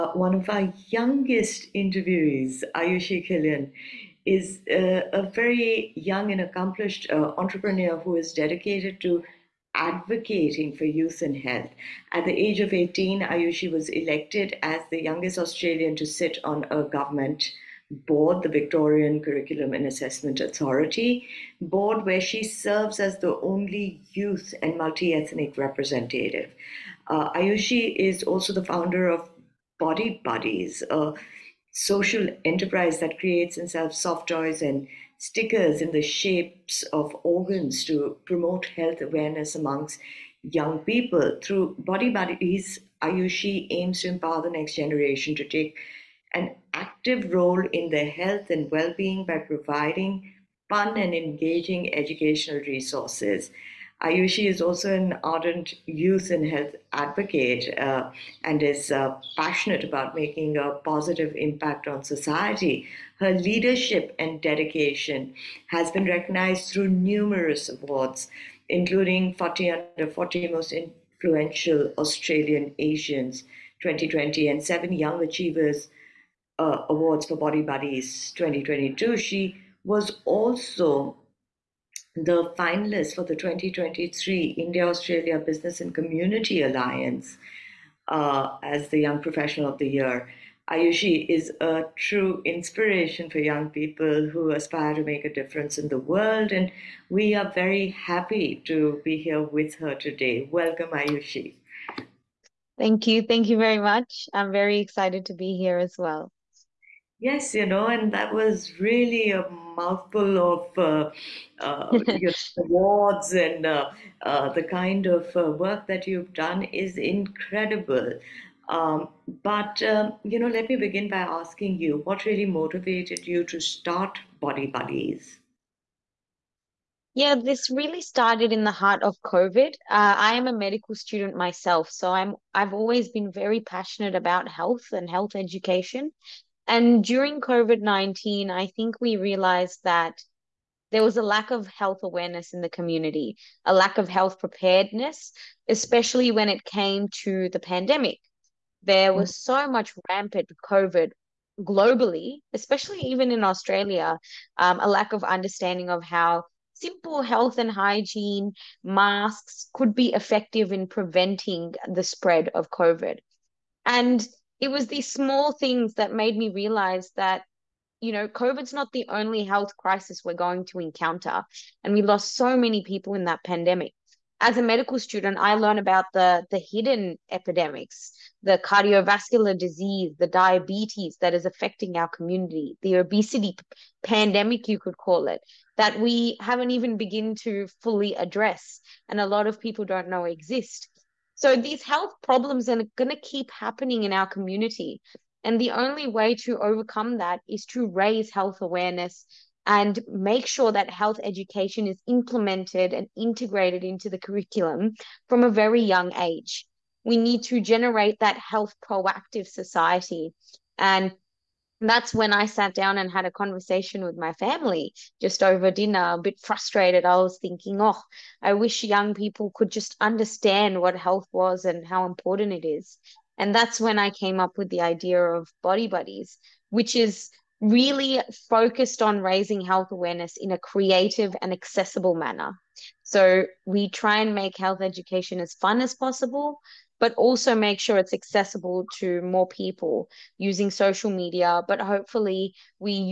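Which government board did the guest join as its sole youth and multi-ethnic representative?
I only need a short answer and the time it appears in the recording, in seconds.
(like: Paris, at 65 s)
Victorian Curriculum and Assessment Authority, at 18 s.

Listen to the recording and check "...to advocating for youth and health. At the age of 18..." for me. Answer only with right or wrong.
right.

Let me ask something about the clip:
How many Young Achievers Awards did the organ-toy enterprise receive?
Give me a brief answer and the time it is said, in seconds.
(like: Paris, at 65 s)
7, at 74 s.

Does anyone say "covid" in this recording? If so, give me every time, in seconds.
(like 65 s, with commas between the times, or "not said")
129 s, 137 s, 150 s, 162 s, 168 s.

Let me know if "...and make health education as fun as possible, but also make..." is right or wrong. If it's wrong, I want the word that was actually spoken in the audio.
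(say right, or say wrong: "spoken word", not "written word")
right.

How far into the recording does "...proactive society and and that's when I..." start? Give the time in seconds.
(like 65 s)
208 s.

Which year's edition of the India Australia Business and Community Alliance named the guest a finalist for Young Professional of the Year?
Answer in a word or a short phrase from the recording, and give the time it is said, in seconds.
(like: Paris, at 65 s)
2023, at 83 s.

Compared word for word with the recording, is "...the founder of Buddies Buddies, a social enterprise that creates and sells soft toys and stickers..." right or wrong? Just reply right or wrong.
wrong.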